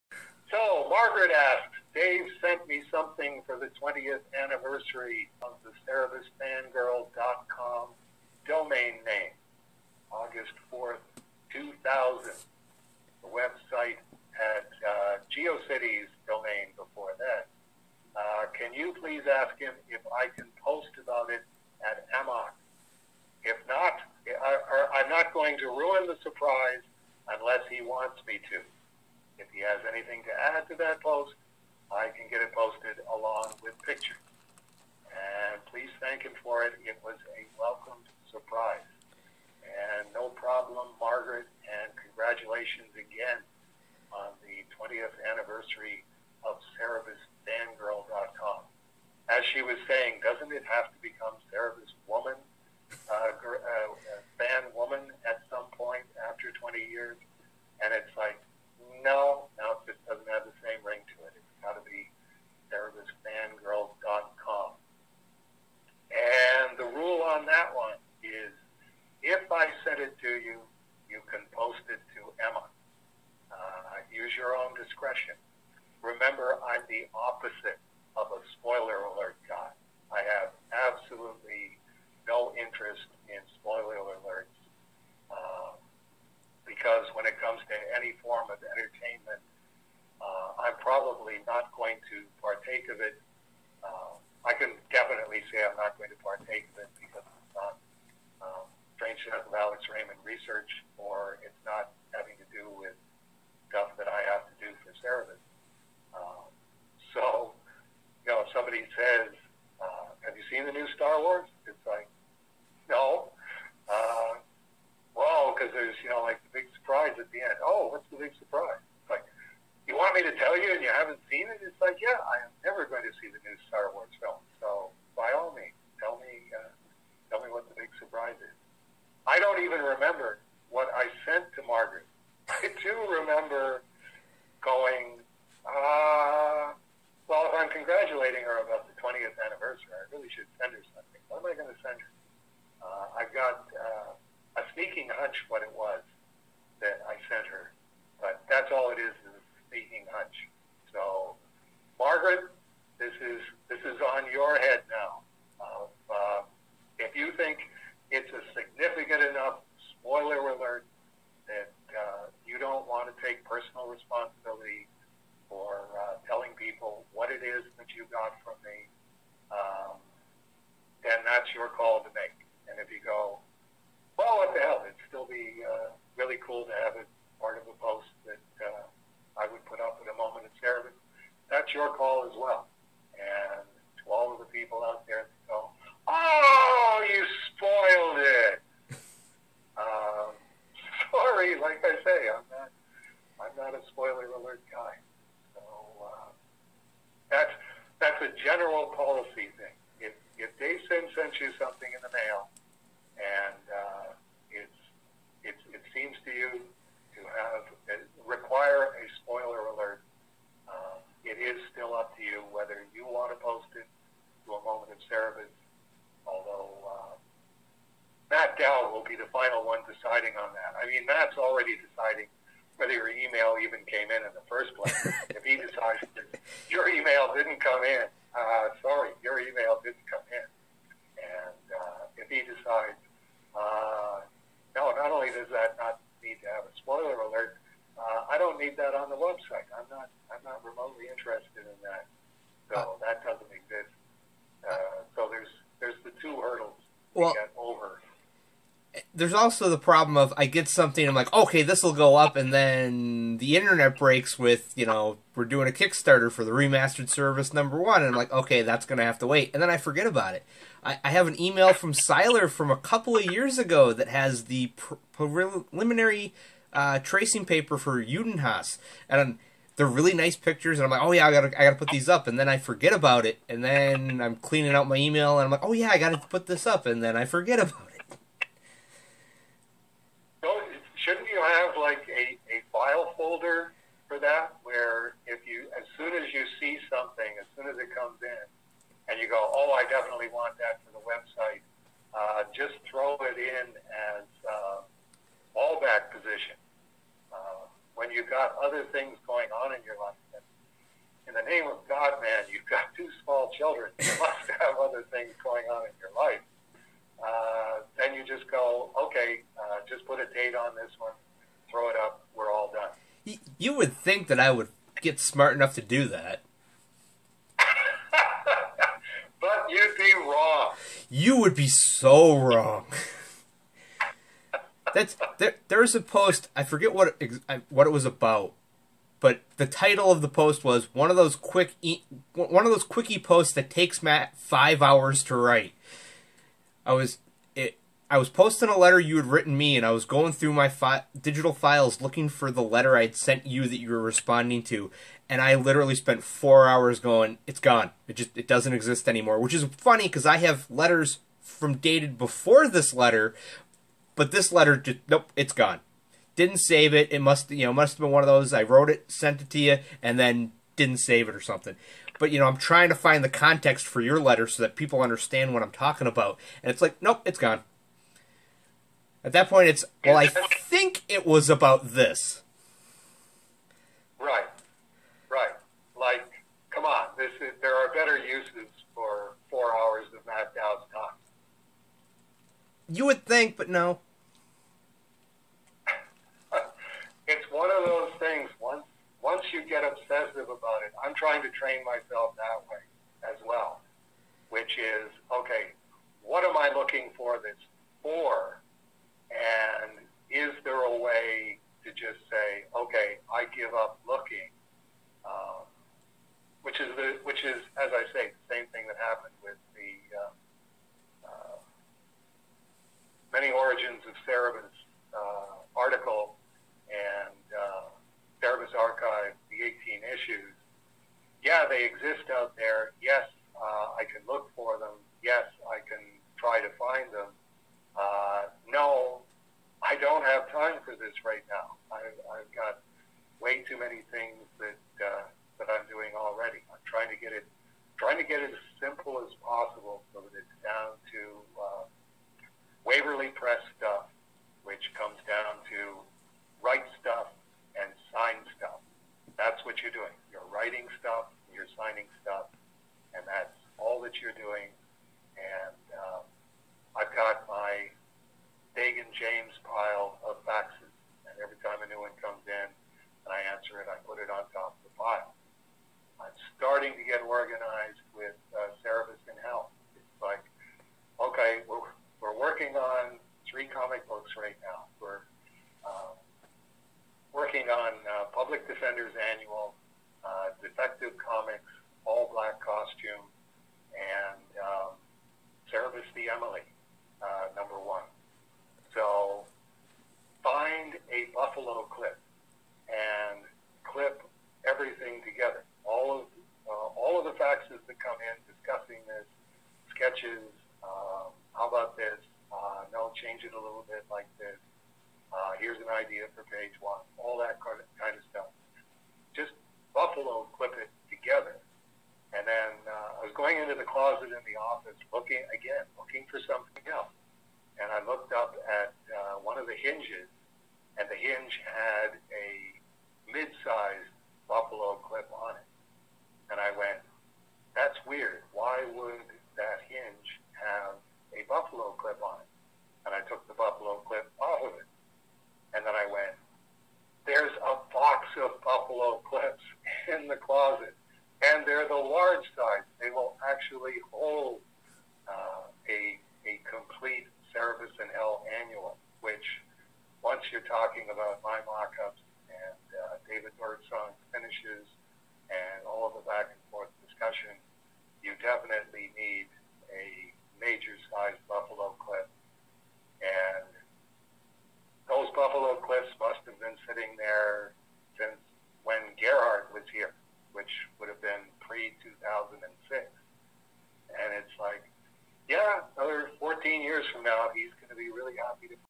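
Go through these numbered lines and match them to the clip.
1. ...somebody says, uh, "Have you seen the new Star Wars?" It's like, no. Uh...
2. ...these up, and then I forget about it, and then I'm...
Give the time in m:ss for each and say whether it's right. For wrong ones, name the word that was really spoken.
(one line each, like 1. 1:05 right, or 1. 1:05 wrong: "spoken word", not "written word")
1. 1:48 right
2. 4:31 right.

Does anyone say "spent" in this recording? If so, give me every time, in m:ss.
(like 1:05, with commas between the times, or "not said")
5:45.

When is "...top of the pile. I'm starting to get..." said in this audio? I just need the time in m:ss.
7:44.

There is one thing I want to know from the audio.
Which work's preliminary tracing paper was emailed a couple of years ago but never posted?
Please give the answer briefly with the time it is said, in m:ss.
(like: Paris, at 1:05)
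Judenhaus, at 4:28.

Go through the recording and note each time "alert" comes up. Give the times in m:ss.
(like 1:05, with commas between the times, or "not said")
1:19, 1:24, 2:40, 3:14, 3:29.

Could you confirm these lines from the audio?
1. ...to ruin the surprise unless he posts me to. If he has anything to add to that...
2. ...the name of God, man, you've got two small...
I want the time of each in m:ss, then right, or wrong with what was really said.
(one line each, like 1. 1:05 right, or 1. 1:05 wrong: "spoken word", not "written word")
1. 0:25 wrong: "wants", not "posts"
2. 5:01 right.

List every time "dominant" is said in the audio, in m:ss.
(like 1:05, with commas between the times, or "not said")
not said.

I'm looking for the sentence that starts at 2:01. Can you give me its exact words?
It's like, yeah, I am never going to see the new Star Wars film.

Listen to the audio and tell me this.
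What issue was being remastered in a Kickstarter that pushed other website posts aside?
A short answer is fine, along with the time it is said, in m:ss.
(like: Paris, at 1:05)
Cerebus number one, at 4:17.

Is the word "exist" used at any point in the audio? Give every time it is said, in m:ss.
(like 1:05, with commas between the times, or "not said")
4:03, 5:48, 7:01.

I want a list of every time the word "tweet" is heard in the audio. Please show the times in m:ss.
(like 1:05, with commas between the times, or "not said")
not said.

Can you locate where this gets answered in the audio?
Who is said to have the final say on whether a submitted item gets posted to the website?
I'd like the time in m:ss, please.
3:38.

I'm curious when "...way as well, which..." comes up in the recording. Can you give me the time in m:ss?
6:32.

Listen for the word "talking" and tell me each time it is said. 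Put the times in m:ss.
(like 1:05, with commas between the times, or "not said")
6:05, 9:10.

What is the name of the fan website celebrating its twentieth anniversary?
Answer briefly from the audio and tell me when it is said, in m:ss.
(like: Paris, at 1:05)
CerebusFangirl.com, at 0:46.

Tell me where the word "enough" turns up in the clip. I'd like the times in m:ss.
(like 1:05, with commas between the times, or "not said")
2:39, 5:15.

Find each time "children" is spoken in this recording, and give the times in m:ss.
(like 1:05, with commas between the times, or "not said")
5:03.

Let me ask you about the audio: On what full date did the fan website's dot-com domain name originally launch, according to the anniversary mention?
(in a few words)
August 4th, 2000.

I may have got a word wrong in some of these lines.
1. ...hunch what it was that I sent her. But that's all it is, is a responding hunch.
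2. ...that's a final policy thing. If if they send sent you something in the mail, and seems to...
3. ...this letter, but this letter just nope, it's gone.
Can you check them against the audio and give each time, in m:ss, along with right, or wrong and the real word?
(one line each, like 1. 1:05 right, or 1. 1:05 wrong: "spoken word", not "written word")
1. 2:25 wrong: "sneaking", not "responding"
2. 3:18 wrong: "general", not "final"
3. 5:52 right.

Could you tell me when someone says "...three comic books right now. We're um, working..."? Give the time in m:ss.
7:53.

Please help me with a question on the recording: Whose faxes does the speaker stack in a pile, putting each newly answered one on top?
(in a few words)
Dagan James.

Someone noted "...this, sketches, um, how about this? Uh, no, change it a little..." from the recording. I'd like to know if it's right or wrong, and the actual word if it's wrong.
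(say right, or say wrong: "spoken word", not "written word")
right.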